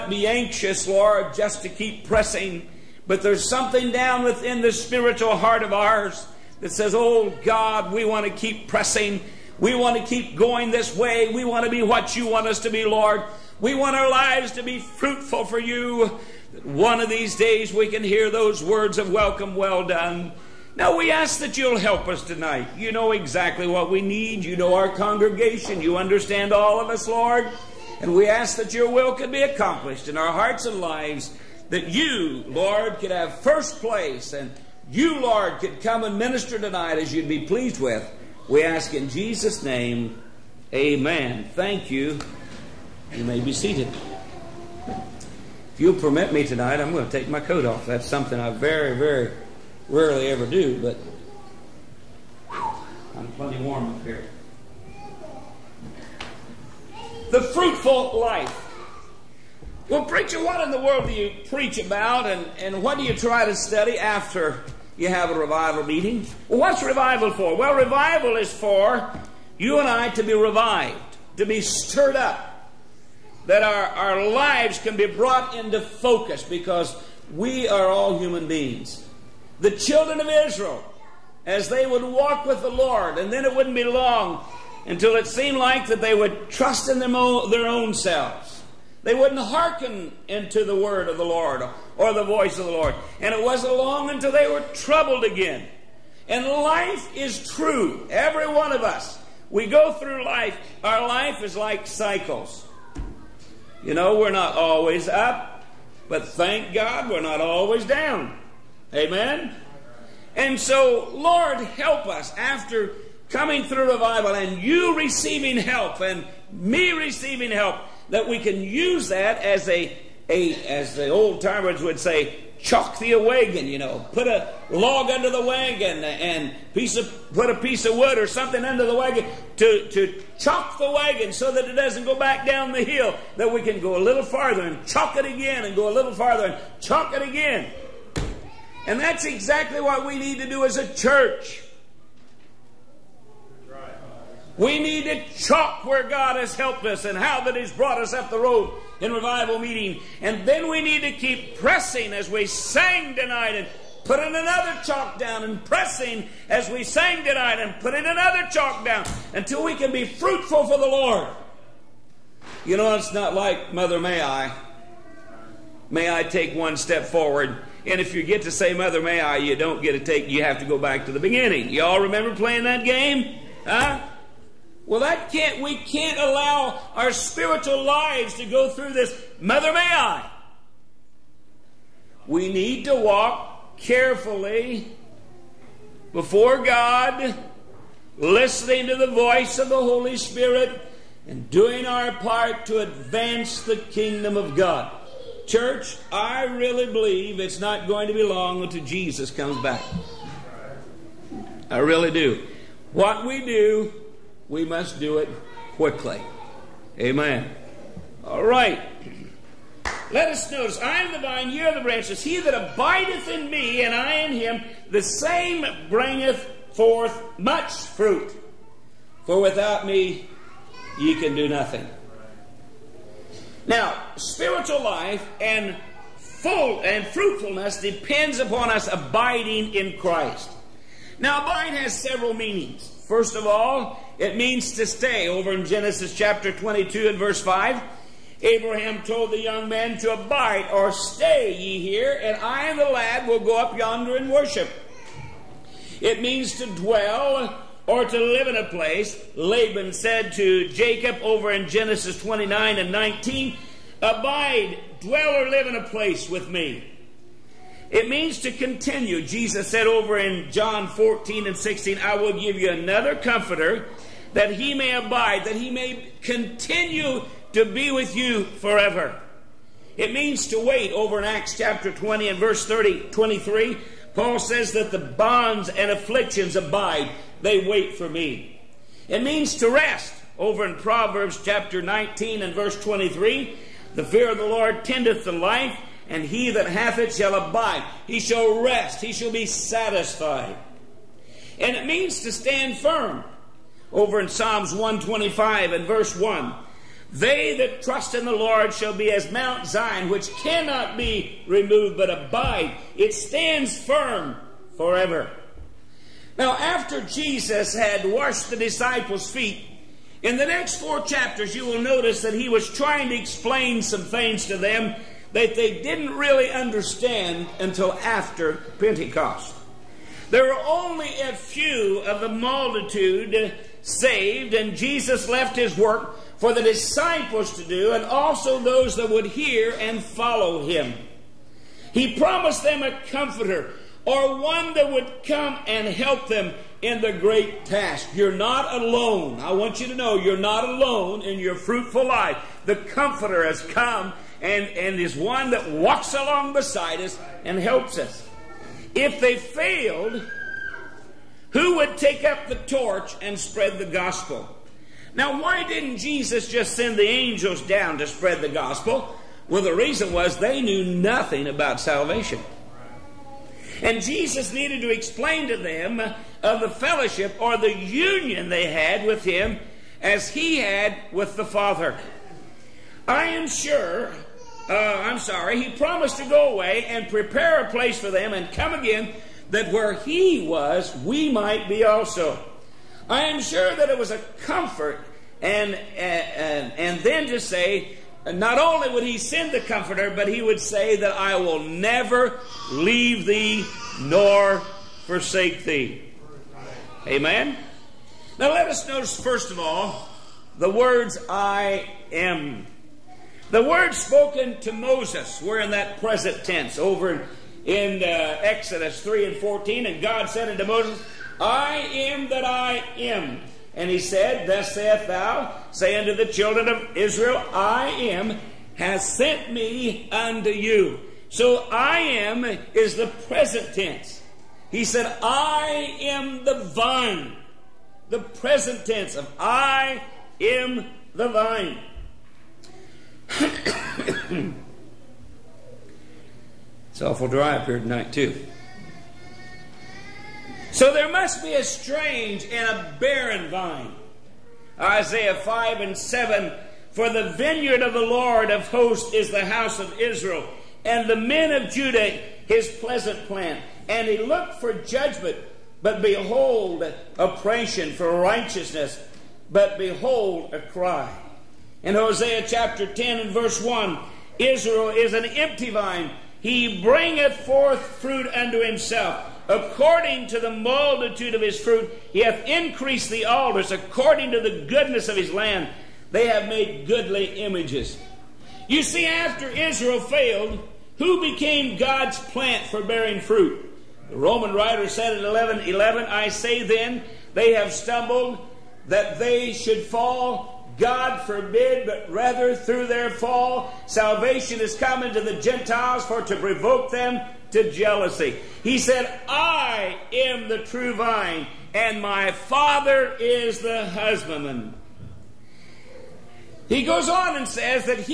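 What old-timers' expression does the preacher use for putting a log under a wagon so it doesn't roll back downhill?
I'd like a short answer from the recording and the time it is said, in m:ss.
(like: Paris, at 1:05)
Chalk the wagon, at 2:02.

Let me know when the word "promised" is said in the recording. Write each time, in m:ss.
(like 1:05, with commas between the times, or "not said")
5:32, 6:15.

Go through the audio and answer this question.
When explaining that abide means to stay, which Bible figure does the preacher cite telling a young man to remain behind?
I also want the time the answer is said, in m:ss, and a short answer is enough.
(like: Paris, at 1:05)
Abraham, at 3:58.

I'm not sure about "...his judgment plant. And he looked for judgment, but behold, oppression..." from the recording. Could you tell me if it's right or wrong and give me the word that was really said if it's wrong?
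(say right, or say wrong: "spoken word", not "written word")
wrong: "pleasant", not "judgment".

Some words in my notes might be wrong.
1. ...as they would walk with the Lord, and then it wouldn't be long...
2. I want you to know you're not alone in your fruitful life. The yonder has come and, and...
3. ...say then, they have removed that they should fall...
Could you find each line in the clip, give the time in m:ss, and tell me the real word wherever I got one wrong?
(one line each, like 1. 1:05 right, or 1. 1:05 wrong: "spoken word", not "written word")
1. 1:21 right
2. 5:39 wrong: "comforter", not "yonder"
3. 8:06 wrong: "stumbled", not "removed".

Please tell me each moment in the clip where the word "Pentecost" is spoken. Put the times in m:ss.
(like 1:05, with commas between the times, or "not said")
5:18.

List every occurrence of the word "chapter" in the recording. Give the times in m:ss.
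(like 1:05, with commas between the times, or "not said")
3:56, 4:31, 4:41, 5:11, 7:42.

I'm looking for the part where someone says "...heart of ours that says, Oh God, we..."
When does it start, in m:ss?
0:05.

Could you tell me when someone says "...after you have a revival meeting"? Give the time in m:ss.
1:03.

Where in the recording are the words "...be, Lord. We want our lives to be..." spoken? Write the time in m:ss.
0:12.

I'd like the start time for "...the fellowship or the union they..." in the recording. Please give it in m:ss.
6:06.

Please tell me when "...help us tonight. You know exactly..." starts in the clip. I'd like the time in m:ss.
0:21.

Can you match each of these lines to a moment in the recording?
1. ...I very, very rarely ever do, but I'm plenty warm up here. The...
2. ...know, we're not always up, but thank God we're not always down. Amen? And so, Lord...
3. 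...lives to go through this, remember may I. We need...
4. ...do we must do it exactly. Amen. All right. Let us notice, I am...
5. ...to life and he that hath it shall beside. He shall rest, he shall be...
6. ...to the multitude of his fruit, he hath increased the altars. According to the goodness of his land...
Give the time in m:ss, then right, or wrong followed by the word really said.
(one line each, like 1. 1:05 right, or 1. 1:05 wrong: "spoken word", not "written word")
1. 0:48 right
2. 1:43 right
3. 2:57 wrong: "mother", not "remember"
4. 3:23 wrong: "quickly", not "exactly"
5. 4:45 wrong: "abide", not "beside"
6. 7:50 right.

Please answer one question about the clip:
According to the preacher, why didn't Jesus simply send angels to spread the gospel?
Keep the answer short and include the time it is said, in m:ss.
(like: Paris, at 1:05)
They knew nothing about salvation, at 6:00.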